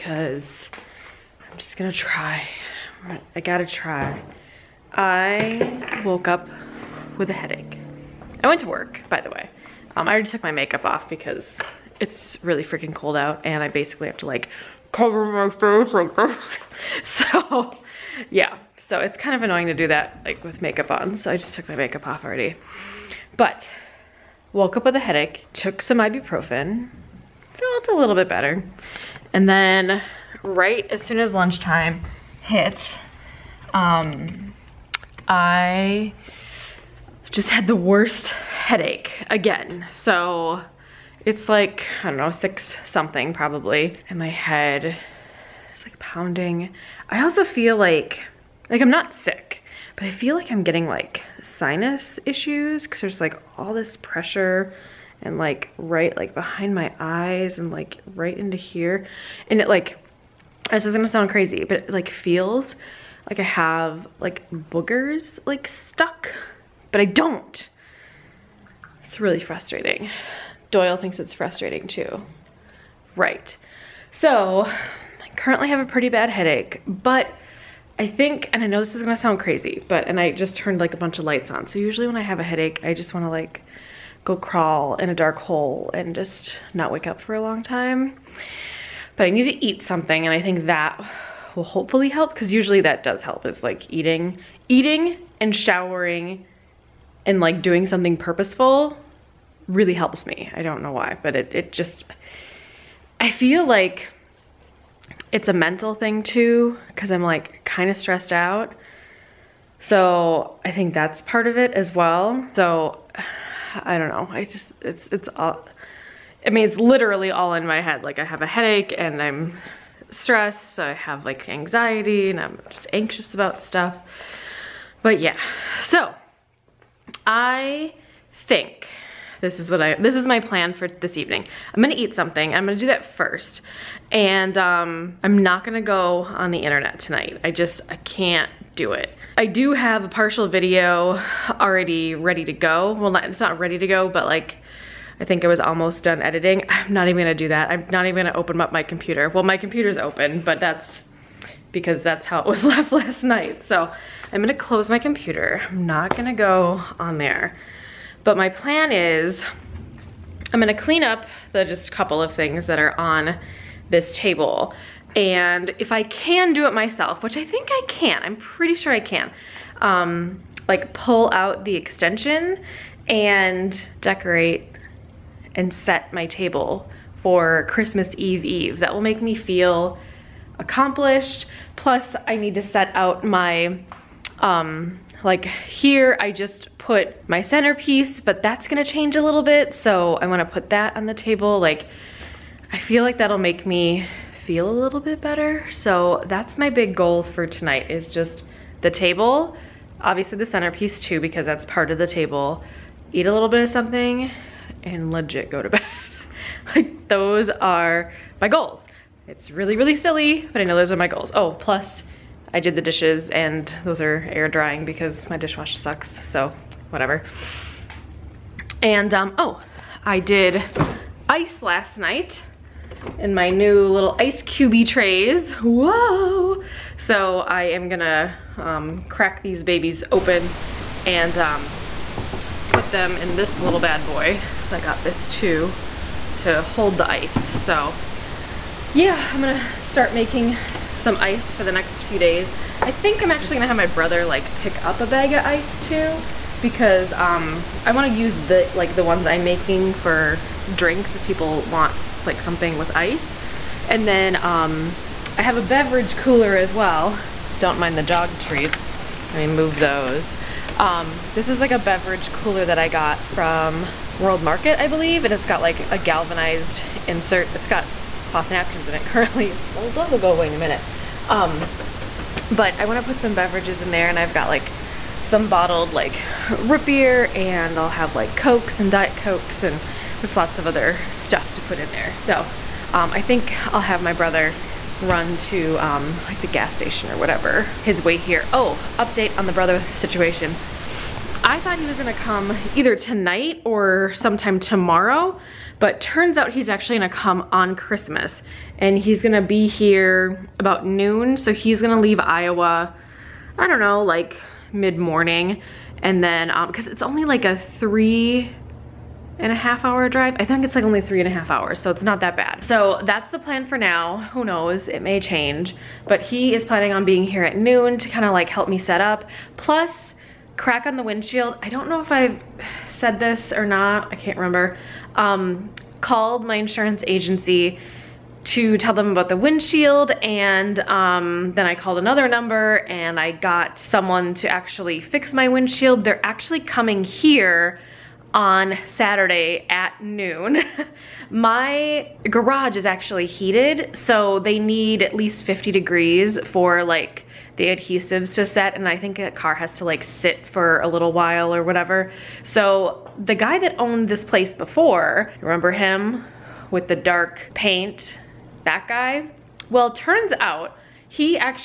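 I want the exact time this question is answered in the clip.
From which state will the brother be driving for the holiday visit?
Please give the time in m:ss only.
5:02.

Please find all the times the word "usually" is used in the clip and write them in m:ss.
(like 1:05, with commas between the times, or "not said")
1:21, 1:32.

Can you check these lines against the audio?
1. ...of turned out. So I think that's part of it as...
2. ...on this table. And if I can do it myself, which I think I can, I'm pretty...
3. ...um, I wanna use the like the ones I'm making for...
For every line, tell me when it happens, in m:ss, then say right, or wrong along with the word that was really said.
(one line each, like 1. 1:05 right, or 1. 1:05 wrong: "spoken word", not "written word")
1. 1:47 wrong: "stressed", not "turned"
2. 2:42 right
3. 4:07 right.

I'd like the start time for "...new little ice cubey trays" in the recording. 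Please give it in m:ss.
3:43.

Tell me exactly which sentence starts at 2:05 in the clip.
But yeah, so I think this is what I, this is my plan for this evening.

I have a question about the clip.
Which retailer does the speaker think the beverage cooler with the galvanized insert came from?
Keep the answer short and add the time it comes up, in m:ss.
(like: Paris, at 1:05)
World Market, at 4:24.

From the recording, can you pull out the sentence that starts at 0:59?
And it like, this is gonna sound crazy, but it like feels like I have like boogers like stuck, but I don't.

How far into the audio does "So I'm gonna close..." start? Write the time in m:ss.
2:33.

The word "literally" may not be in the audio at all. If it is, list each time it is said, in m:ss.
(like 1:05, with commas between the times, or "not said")
1:56.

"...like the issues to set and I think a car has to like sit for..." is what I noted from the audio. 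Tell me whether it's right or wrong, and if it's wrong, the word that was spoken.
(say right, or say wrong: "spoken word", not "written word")
wrong: "adhesives", not "issues".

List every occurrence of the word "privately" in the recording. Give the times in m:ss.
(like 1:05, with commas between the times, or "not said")
not said.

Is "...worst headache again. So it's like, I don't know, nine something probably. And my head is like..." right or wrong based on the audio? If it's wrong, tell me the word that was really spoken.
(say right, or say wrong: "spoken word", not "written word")
wrong: "six", not "nine".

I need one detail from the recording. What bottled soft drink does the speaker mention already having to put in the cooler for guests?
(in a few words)
root beer.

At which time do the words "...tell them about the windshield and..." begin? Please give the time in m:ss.
5:28.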